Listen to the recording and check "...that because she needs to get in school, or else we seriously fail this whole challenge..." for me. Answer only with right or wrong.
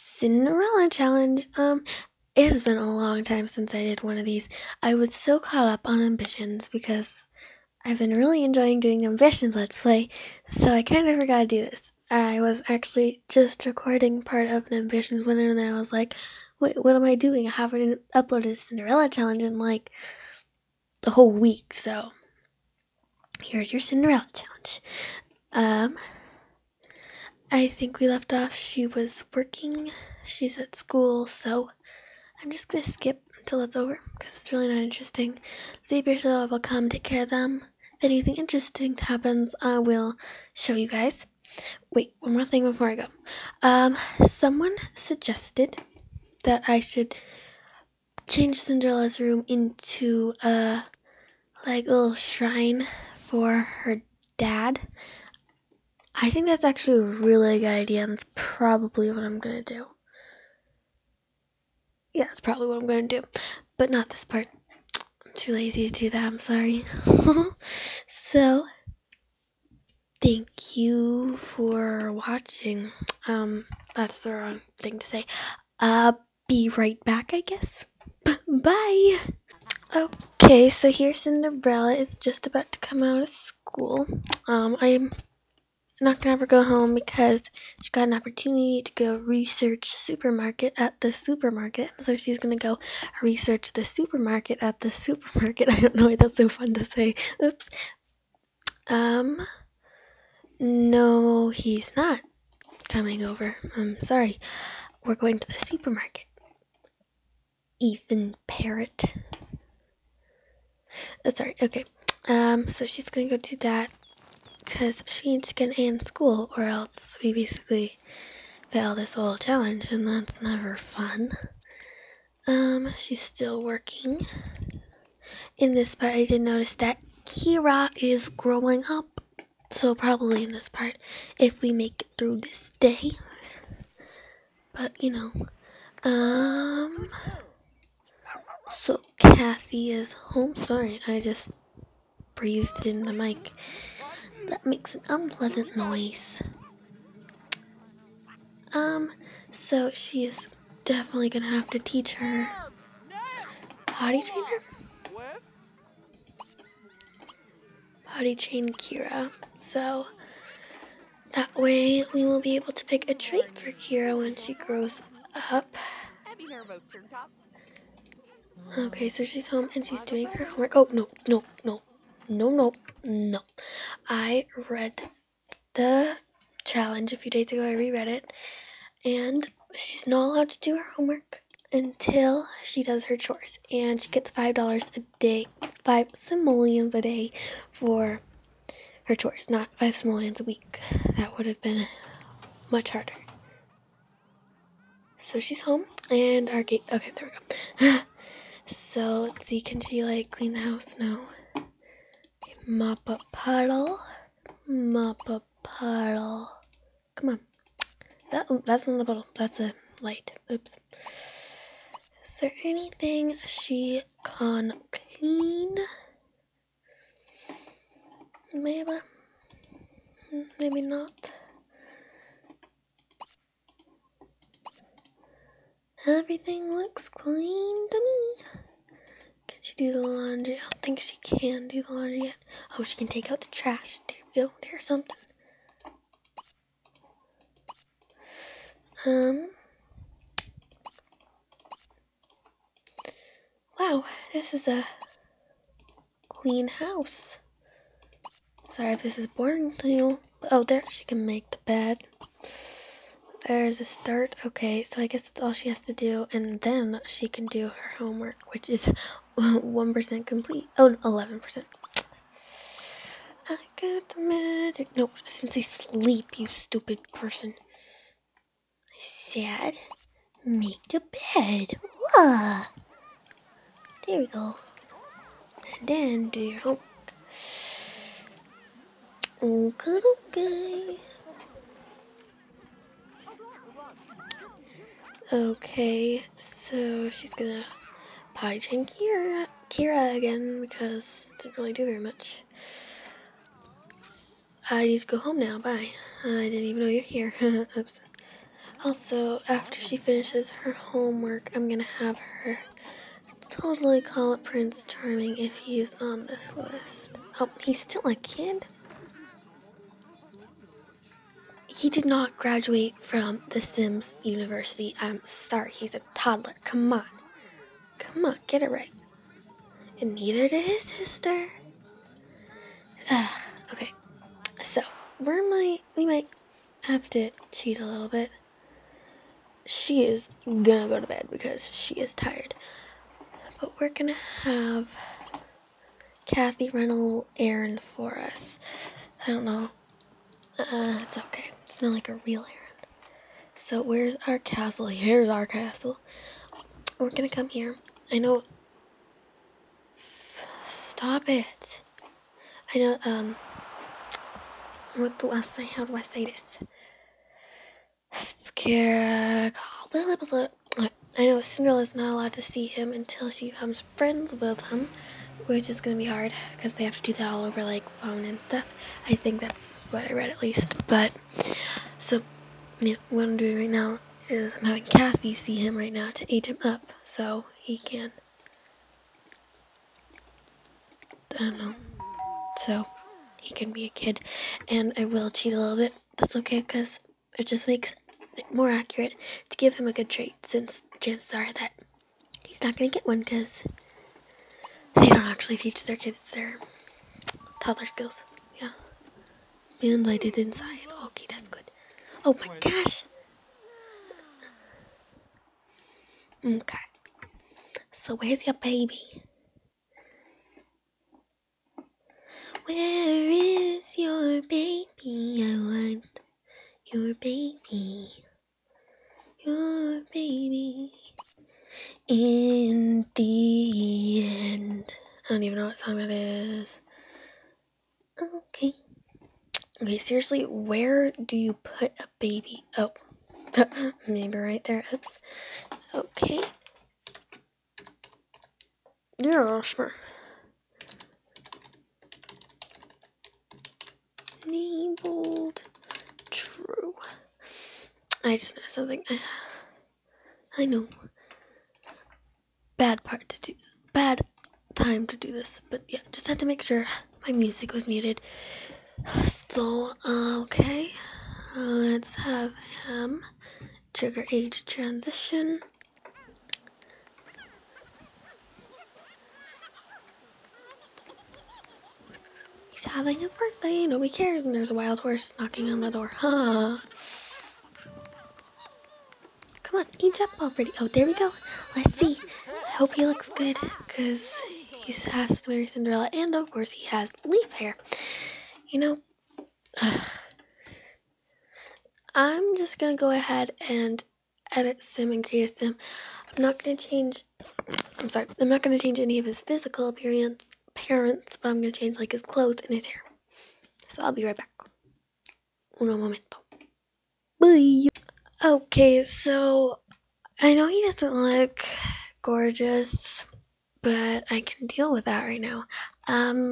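wrong.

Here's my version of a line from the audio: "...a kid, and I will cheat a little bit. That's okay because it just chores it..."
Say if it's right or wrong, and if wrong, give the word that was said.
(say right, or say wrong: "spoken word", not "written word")
wrong: "makes", not "chores".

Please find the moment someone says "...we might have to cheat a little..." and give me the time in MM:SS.
05:25.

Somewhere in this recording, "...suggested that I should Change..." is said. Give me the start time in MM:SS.
00:44.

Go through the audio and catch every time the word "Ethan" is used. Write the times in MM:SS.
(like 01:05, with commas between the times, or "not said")
01:47.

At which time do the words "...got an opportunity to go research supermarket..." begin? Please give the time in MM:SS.
01:27.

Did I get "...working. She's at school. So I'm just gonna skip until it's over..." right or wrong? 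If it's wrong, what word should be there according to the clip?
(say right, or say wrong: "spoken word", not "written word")
right.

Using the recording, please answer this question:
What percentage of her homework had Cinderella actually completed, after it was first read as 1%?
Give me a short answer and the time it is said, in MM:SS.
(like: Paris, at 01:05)
11%, at 04:20.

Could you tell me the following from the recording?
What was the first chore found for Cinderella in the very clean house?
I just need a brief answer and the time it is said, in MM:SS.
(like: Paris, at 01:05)
Take out the trash, at 03:53.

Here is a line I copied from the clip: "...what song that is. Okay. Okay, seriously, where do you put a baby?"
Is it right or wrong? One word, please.
right.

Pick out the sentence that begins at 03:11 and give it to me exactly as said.
That would have been much harder.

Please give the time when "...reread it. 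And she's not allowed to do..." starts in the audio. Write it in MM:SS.
02:57.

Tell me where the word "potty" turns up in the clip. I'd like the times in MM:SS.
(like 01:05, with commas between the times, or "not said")
02:33, 02:38, 04:48.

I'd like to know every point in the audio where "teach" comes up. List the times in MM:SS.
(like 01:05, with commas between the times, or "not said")
02:31, 06:35.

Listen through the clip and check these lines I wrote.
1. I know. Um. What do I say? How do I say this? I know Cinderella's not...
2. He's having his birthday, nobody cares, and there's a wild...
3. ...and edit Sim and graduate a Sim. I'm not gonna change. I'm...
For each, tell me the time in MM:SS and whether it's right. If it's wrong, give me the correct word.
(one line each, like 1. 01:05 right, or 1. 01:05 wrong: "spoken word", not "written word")
1. 05:52 right
2. 07:52 right
3. 08:13 wrong: "create", not "graduate".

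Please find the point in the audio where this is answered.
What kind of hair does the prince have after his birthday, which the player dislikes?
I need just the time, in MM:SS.
08:07.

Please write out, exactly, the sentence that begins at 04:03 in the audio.
Wow, this is a clean house.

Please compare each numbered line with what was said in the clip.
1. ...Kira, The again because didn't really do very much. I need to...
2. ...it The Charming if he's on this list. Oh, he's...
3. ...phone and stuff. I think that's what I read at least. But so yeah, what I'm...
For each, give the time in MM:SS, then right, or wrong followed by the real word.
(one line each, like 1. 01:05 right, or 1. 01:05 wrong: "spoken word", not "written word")
1. 04:48 wrong: "Kira", not "The"
2. 05:04 wrong: "Prince", not "The"
3. 06:07 right.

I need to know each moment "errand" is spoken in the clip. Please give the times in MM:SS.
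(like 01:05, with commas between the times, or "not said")
05:37, 05:42.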